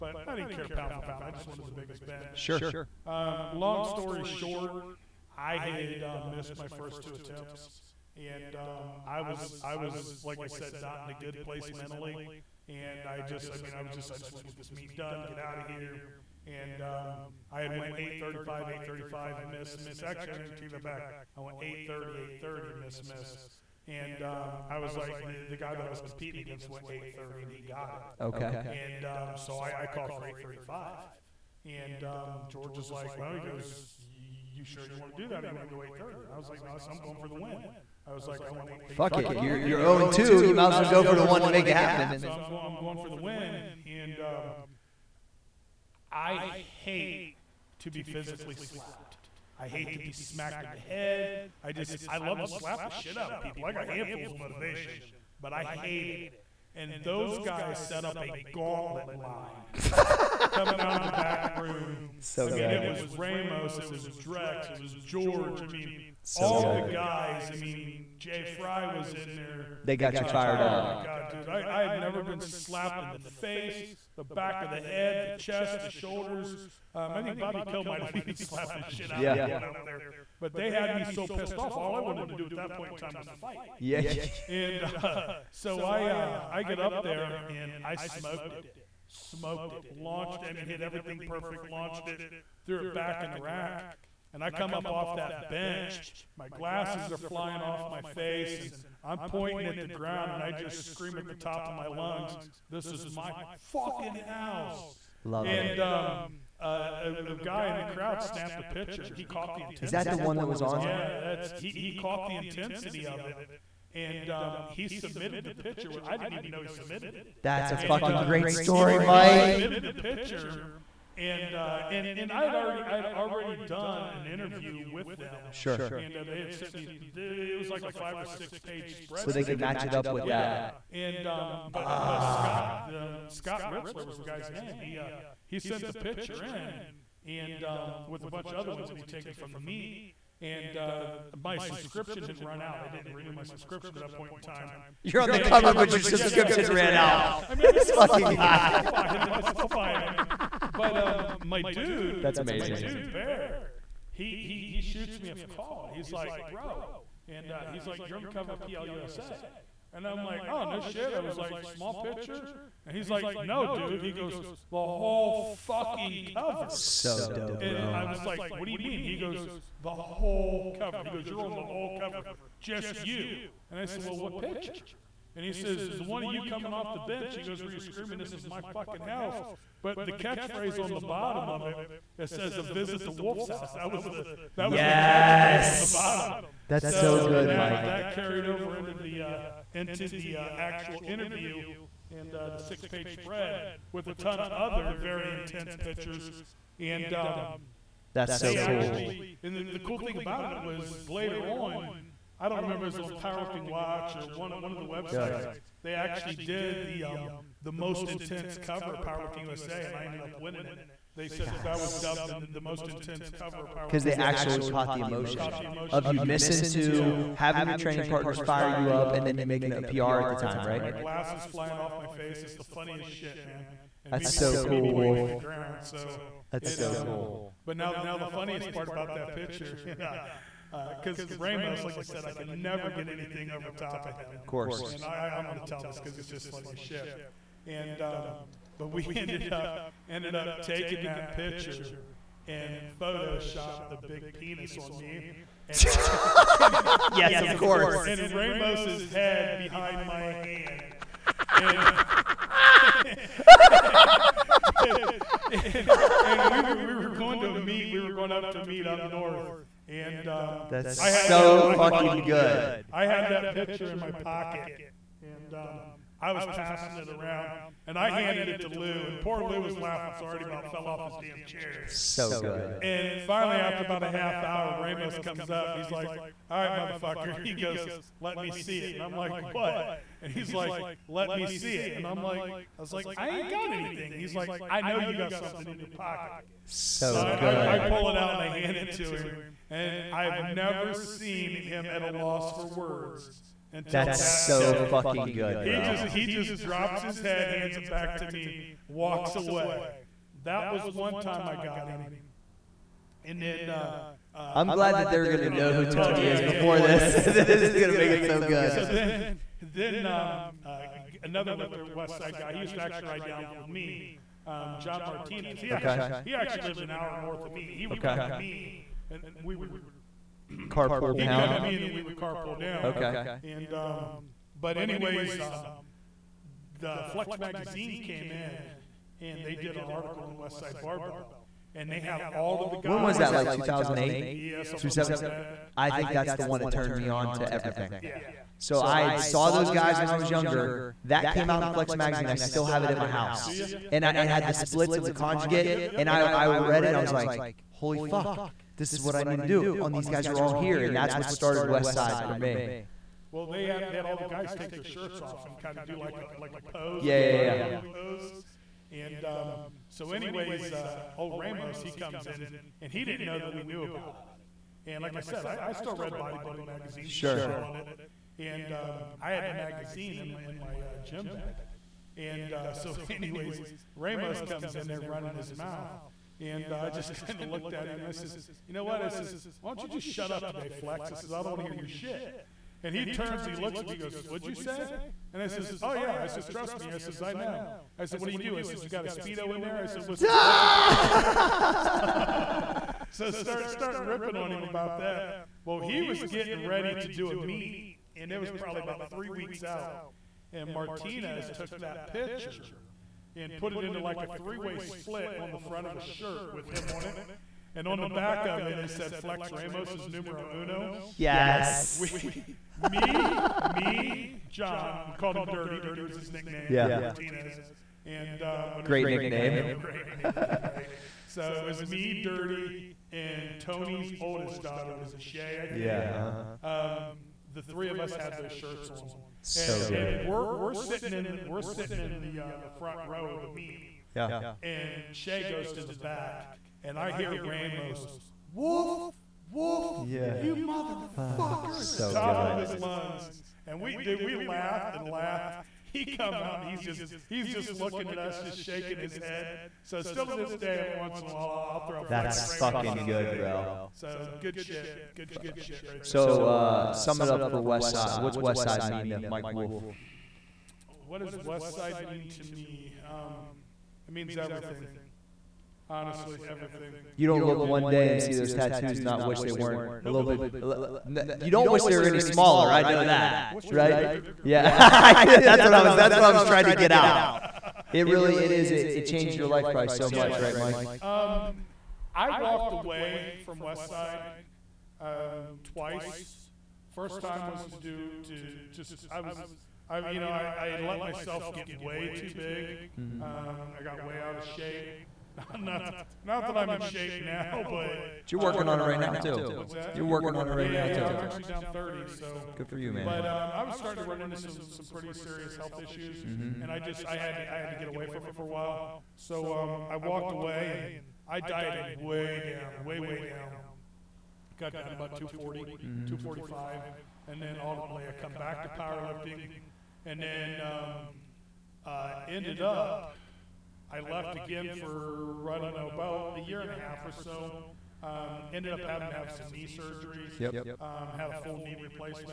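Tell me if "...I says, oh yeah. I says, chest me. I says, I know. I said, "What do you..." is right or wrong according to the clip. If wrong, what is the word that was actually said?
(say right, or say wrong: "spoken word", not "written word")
wrong: "trust", not "chest".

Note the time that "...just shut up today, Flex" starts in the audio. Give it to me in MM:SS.
06:19.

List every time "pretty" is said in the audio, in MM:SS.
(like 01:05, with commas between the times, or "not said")
08:24.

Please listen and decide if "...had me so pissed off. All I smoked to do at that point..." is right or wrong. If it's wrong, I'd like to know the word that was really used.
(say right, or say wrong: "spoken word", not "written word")
wrong: "wanted", not "smoked".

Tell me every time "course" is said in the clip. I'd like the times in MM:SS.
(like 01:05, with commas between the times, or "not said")
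03:54, 04:07.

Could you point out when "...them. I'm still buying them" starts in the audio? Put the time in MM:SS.
02:29.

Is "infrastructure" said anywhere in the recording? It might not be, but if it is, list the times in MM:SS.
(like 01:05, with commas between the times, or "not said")
not said.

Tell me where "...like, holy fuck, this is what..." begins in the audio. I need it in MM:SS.
05:47.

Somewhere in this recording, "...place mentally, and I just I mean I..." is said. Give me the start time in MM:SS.
00:11.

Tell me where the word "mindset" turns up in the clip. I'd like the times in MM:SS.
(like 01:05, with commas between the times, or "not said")
not said.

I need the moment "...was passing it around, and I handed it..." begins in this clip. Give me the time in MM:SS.
04:26.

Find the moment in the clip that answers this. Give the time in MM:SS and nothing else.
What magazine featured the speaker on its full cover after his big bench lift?
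02:38.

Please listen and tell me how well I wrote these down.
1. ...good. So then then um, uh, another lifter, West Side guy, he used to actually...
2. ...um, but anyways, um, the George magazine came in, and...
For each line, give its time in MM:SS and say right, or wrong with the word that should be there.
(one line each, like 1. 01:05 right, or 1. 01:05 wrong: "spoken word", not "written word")
1. 05:08 right
2. 05:23 wrong: "Flex", not "George".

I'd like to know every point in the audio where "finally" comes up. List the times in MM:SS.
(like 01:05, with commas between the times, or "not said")
04:33.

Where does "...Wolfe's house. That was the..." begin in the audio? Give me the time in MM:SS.
03:03.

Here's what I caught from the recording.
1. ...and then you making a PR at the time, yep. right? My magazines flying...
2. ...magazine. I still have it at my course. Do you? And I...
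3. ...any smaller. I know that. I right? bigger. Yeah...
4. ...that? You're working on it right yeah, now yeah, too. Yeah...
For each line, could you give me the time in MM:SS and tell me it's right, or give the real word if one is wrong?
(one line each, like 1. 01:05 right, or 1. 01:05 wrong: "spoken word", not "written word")
1. 03:39 wrong: "glasses", not "magazines"
2. 05:41 wrong: "house", not "course"
3. 07:52 right
4. 08:19 right.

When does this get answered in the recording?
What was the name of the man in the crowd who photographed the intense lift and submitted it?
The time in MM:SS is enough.
02:13.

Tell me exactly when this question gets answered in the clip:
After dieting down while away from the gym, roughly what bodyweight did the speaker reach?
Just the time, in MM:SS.
08:35.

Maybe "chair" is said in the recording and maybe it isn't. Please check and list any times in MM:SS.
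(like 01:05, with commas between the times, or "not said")
04:31.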